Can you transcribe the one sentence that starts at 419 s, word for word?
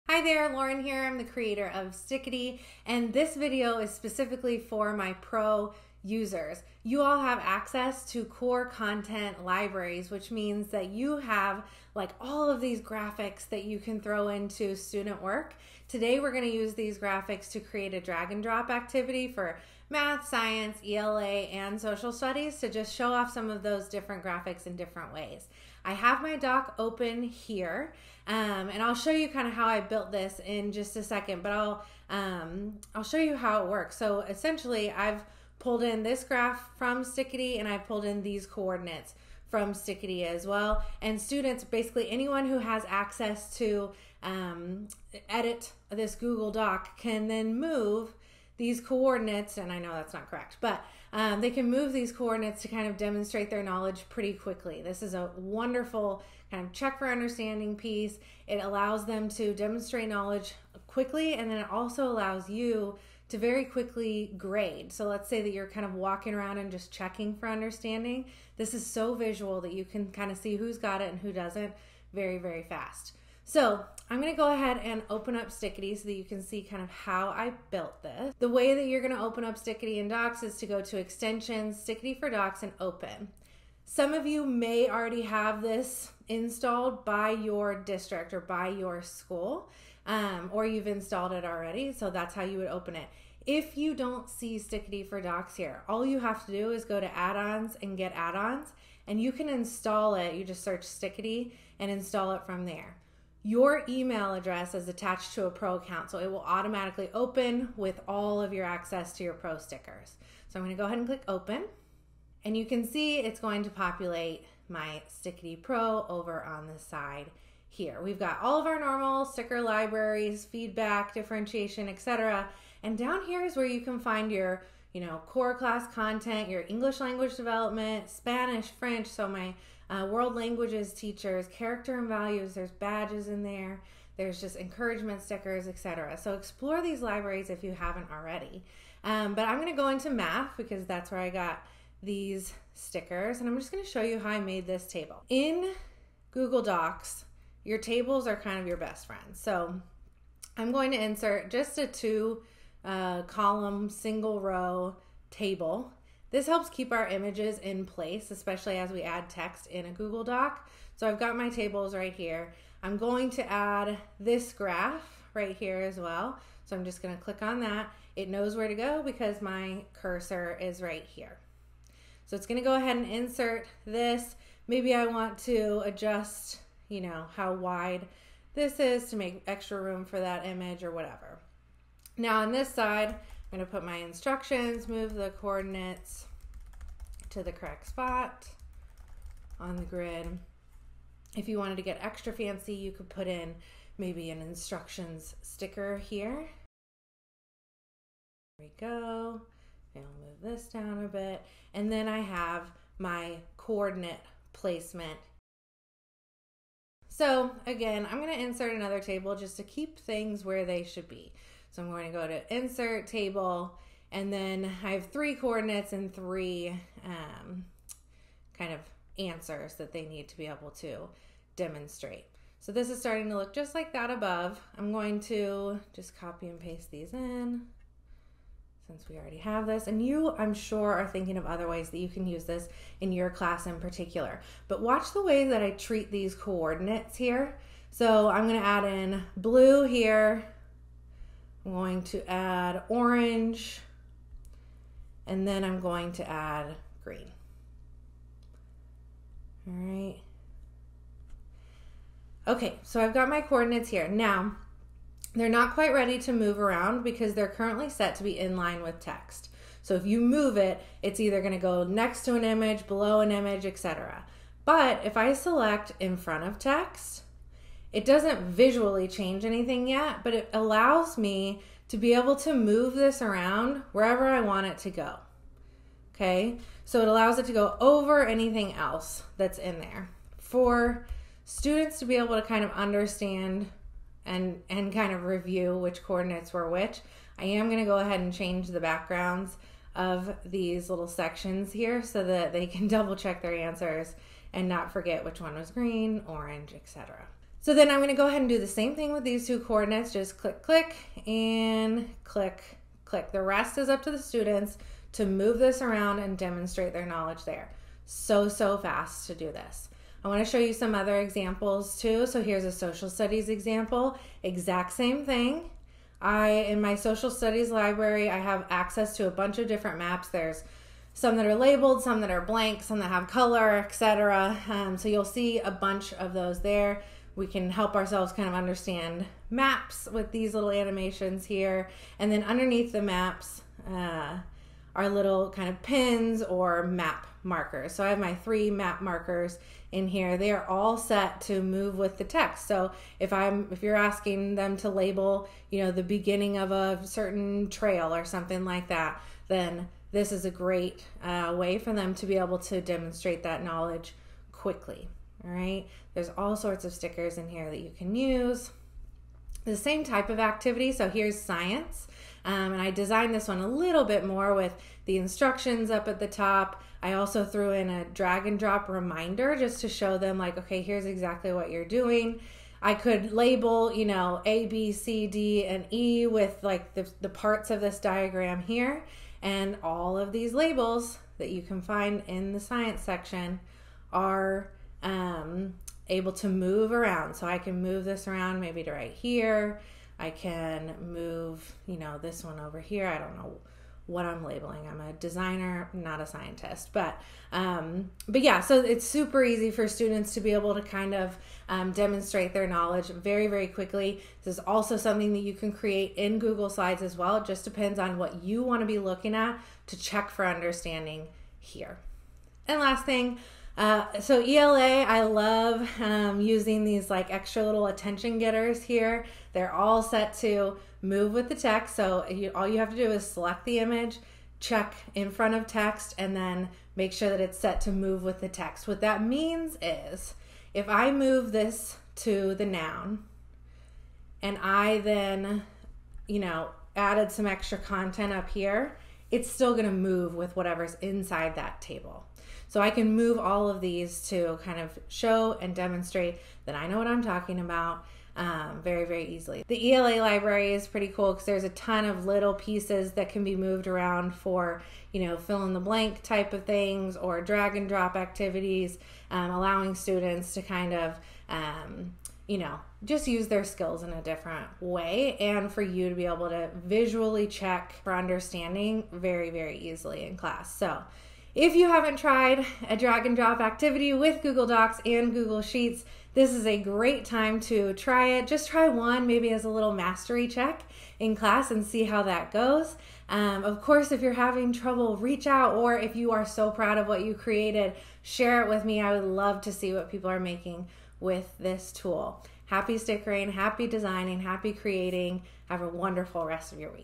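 They're all set to move with the text.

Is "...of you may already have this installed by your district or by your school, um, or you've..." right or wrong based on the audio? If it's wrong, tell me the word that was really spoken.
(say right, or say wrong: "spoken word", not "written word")
right.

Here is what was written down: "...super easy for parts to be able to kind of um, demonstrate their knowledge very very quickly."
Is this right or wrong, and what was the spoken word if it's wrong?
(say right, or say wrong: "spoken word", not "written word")
wrong: "students", not "parts".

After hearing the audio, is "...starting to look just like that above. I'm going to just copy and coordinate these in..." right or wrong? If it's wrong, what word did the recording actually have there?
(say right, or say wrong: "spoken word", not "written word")
wrong: "paste", not "coordinate".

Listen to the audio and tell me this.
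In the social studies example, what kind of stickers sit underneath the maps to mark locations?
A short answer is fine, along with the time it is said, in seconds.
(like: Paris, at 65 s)
pins or map markers, at 335 s.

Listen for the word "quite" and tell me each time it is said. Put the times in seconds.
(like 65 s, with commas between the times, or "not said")
255 s.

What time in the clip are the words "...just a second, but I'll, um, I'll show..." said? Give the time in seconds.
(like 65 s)
30 s.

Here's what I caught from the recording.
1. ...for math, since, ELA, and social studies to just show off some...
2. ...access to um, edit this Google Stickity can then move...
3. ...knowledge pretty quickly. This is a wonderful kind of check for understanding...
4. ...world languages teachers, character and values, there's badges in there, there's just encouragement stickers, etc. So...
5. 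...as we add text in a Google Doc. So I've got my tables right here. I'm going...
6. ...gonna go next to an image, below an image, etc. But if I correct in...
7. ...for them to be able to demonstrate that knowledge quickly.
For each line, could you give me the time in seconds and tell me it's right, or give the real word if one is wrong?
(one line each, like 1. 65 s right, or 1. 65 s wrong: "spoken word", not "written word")
1. 19 s wrong: "science", not "since"
2. 42 s wrong: "Doc", not "Stickity"
3. 53 s right
4. 130 s right
5. 158 s right
6. 261 s wrong: "select", not "correct"
7. 351 s right.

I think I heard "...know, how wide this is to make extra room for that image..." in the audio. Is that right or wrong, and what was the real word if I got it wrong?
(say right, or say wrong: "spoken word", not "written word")
right.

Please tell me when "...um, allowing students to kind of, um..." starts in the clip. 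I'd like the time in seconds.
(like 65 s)
459 s.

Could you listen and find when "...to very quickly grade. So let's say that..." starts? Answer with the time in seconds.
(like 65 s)
63 s.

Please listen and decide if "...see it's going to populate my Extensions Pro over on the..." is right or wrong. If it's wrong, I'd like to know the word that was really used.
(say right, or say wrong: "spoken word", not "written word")
wrong: "Stickity", not "Extensions".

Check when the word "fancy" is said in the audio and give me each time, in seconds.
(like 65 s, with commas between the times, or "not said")
192 s.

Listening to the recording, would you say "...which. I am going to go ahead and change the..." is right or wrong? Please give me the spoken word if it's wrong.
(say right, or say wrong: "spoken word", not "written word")
right.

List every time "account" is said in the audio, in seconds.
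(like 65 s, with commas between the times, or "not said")
105 s.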